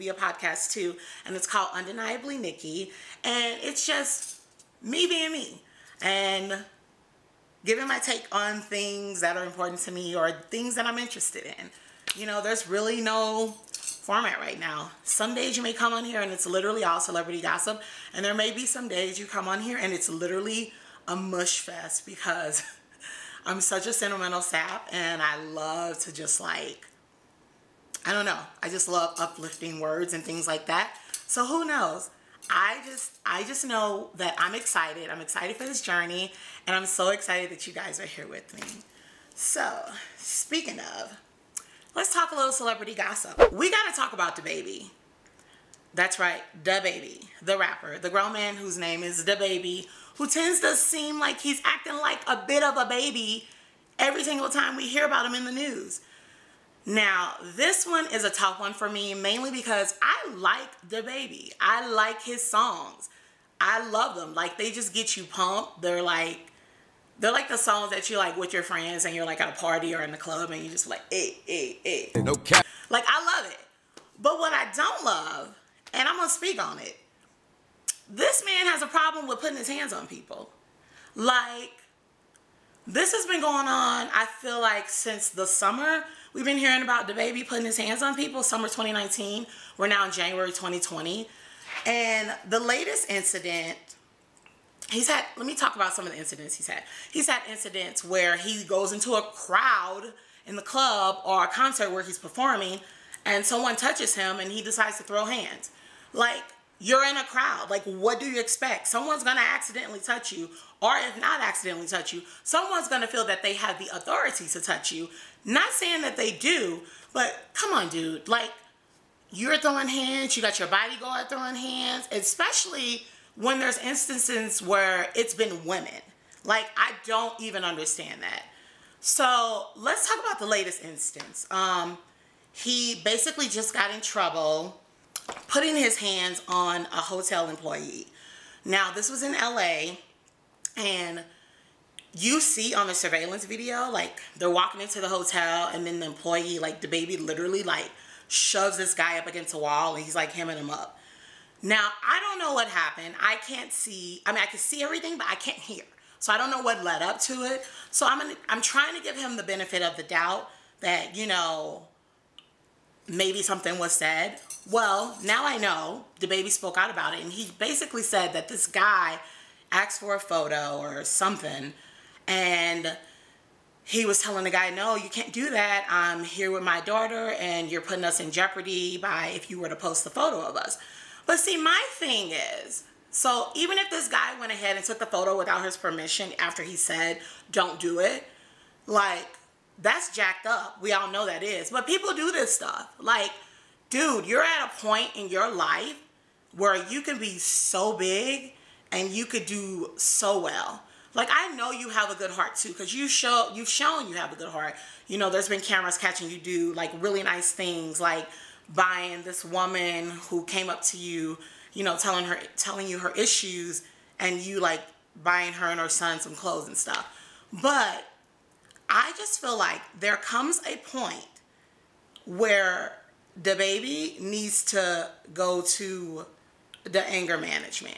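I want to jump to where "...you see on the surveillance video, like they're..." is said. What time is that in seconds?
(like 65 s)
142 s.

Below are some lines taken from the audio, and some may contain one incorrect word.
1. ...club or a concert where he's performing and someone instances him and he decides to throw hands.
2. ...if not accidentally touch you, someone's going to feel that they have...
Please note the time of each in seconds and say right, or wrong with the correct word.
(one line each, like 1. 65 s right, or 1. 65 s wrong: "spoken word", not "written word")
1. 100 s wrong: "touches", not "instances"
2. 110 s right.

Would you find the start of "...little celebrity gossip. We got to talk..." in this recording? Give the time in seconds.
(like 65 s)
42 s.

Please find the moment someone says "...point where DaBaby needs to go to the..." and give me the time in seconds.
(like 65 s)
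220 s.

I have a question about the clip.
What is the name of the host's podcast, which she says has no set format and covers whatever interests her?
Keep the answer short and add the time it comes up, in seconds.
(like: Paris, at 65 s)
Undeniably Nikki, at 1 s.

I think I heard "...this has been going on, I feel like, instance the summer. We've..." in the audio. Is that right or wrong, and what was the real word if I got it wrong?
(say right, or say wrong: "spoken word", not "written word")
wrong: "since", not "instance".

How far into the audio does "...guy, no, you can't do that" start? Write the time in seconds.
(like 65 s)
174 s.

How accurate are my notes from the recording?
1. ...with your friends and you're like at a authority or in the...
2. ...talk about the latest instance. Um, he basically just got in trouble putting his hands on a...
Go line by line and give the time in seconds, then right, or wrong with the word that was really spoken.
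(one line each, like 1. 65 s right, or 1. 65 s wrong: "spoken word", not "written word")
1. 68 s wrong: "party", not "authority"
2. 130 s right.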